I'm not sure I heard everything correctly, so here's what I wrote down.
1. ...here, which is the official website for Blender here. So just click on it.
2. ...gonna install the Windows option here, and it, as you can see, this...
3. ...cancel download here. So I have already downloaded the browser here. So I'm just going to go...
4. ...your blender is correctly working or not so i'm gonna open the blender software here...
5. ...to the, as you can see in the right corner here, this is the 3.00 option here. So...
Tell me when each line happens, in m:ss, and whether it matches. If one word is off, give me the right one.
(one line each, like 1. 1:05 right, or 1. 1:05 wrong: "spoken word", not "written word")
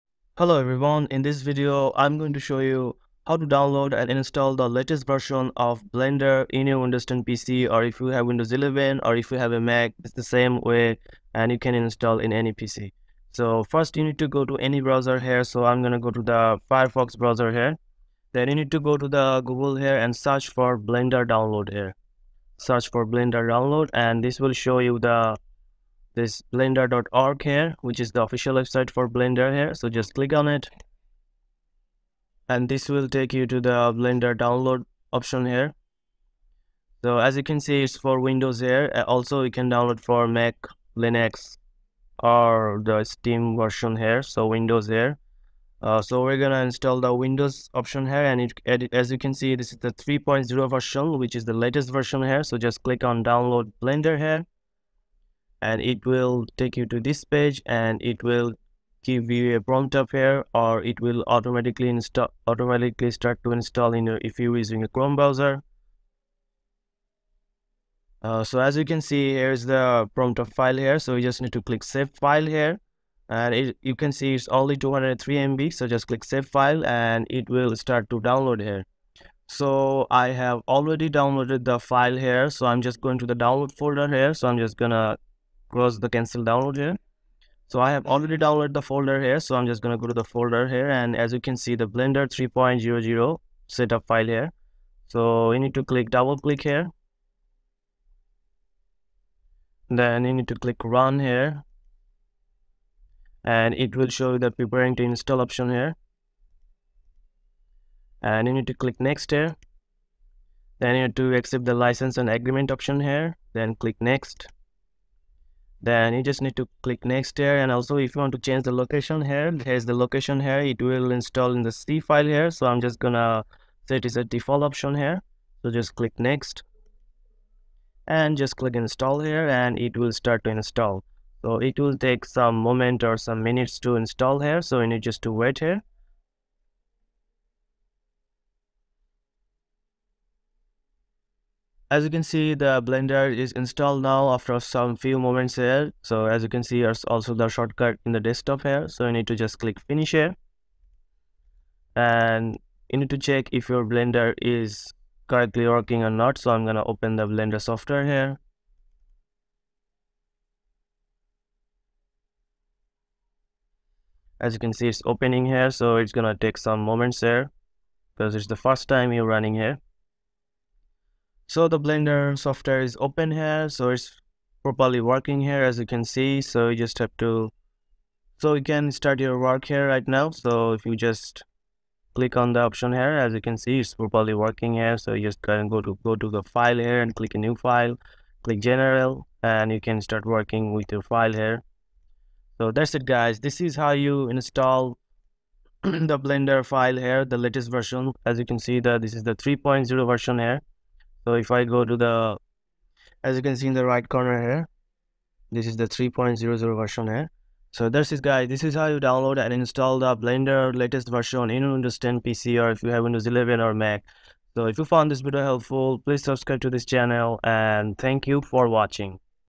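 1. 0:27 right
2. 0:46 right
3. 1:26 wrong: "folder", not "browser"
4. 2:33 right
5. 3:21 wrong: "version", not "option".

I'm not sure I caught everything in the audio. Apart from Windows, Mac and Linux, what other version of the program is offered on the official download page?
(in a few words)
Steam.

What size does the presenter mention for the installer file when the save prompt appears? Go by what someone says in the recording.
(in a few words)
203 MB.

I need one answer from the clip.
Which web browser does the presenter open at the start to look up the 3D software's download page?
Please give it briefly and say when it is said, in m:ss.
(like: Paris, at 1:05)
Firefox, at 0:16.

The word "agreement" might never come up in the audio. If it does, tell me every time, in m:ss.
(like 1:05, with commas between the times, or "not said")
1:52.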